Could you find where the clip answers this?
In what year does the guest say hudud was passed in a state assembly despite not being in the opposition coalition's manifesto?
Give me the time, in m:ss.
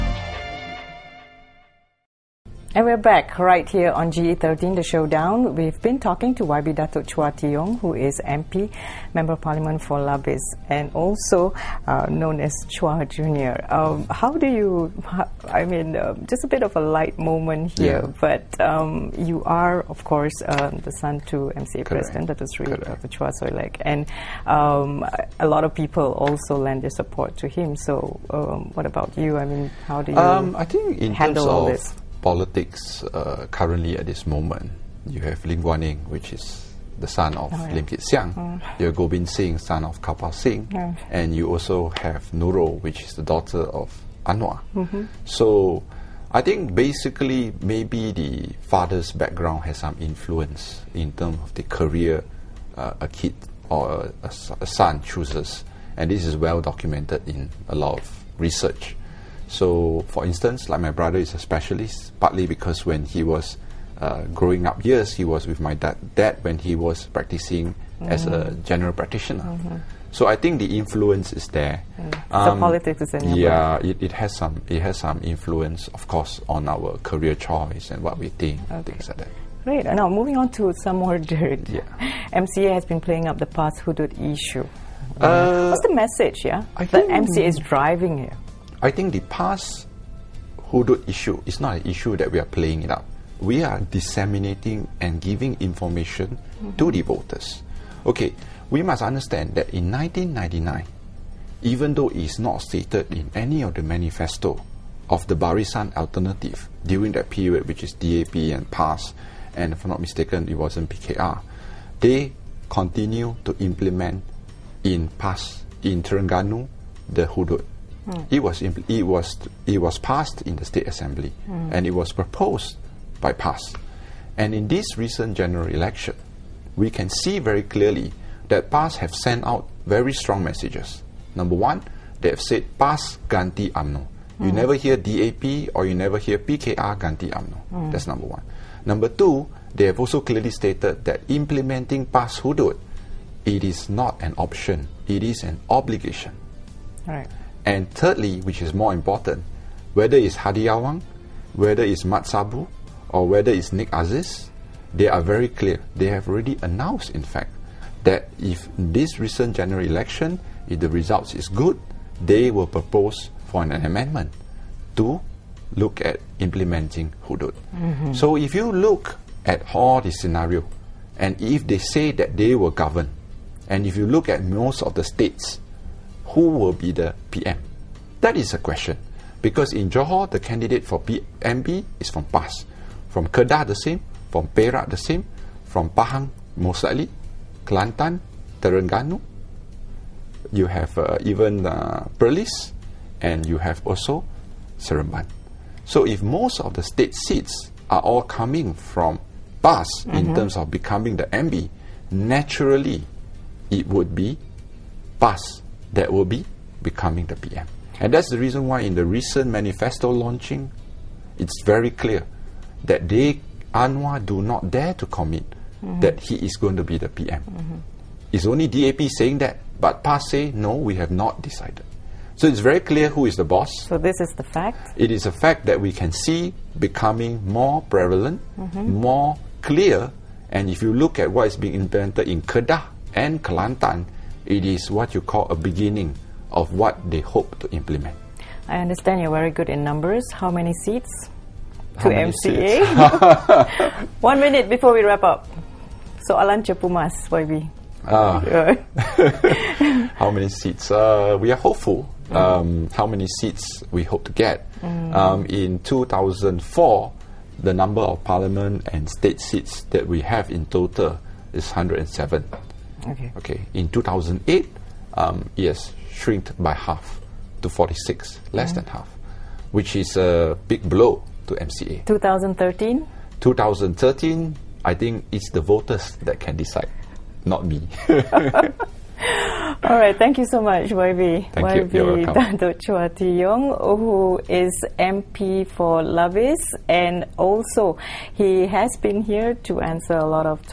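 1:39.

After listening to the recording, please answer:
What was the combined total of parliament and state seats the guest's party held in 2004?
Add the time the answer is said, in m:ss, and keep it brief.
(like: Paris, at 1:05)
107, at 4:21.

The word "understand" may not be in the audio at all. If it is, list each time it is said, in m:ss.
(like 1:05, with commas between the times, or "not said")
1:39, 3:58.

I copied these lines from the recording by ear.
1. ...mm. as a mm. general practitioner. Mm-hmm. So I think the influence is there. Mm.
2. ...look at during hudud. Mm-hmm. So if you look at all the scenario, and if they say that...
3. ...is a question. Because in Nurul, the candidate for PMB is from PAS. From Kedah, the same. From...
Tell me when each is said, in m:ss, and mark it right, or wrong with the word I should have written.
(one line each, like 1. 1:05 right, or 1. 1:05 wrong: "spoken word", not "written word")
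1. 1:08 right
2. 2:45 wrong: "implementing", not "during"
3. 2:58 wrong: "Johor", not "Nurul".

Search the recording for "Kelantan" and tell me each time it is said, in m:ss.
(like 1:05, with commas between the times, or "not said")
3:07, 3:53.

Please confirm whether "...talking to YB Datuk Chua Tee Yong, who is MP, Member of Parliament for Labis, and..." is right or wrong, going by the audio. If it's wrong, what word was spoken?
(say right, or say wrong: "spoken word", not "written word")
right.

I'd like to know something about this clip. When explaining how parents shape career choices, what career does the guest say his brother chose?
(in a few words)
Specialist.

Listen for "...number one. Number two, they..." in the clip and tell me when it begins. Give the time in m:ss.
2:18.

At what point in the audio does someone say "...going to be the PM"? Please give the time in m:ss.
3:36.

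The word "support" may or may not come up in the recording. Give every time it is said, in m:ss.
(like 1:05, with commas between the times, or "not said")
0:26.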